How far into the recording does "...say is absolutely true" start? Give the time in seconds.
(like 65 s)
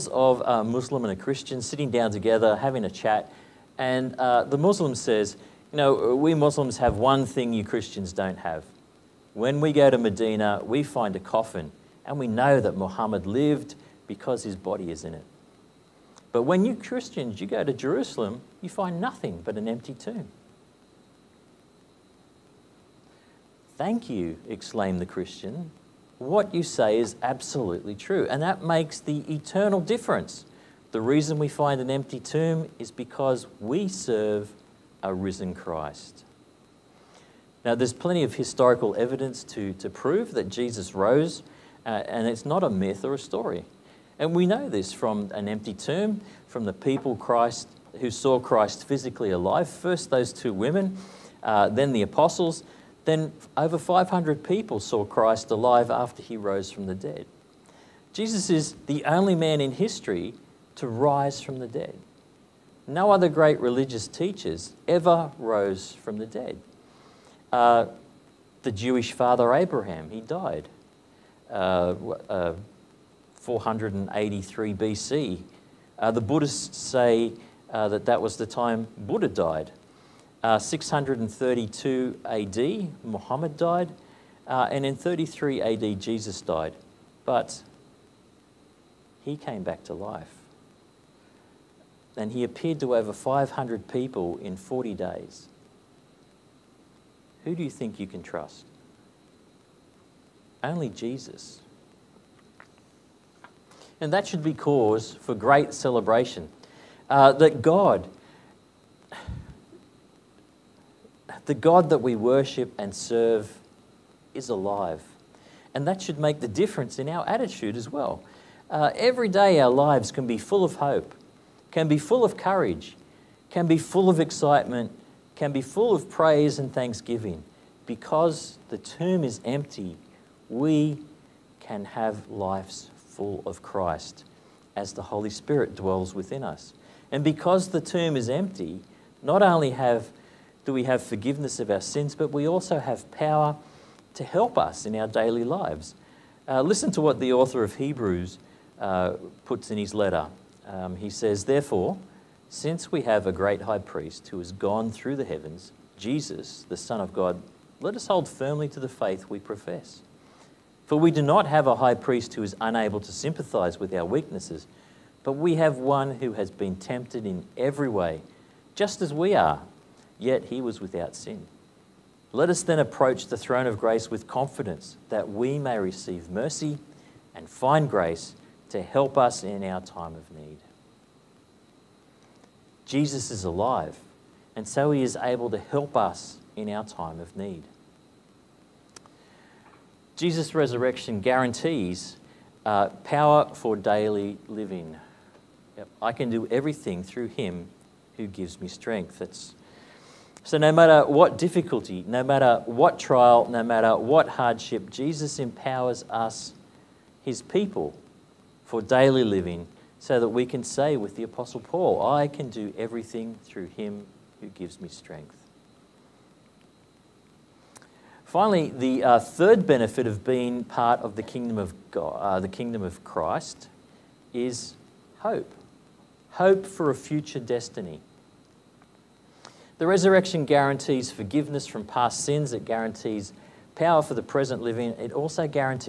26 s.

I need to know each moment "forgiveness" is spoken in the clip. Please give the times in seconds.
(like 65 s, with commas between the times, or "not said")
141 s, 231 s.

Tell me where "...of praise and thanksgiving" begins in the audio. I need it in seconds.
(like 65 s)
125 s.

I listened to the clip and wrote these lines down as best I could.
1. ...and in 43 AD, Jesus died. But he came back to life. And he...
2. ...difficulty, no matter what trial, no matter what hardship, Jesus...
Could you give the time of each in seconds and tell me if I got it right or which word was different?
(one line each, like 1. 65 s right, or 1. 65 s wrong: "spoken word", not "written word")
1. 84 s wrong: "33", not "43"
2. 201 s right.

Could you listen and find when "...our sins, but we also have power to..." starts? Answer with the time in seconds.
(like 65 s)
141 s.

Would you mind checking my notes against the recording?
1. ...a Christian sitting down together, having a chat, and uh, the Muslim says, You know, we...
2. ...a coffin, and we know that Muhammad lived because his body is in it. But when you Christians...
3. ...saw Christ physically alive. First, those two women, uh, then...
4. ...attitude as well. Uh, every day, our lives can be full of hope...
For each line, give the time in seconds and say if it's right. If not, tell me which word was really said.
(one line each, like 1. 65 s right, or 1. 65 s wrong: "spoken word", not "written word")
1. 1 s right
2. 11 s right
3. 48 s right
4. 117 s right.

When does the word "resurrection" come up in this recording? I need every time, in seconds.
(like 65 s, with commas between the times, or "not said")
190 s, 229 s.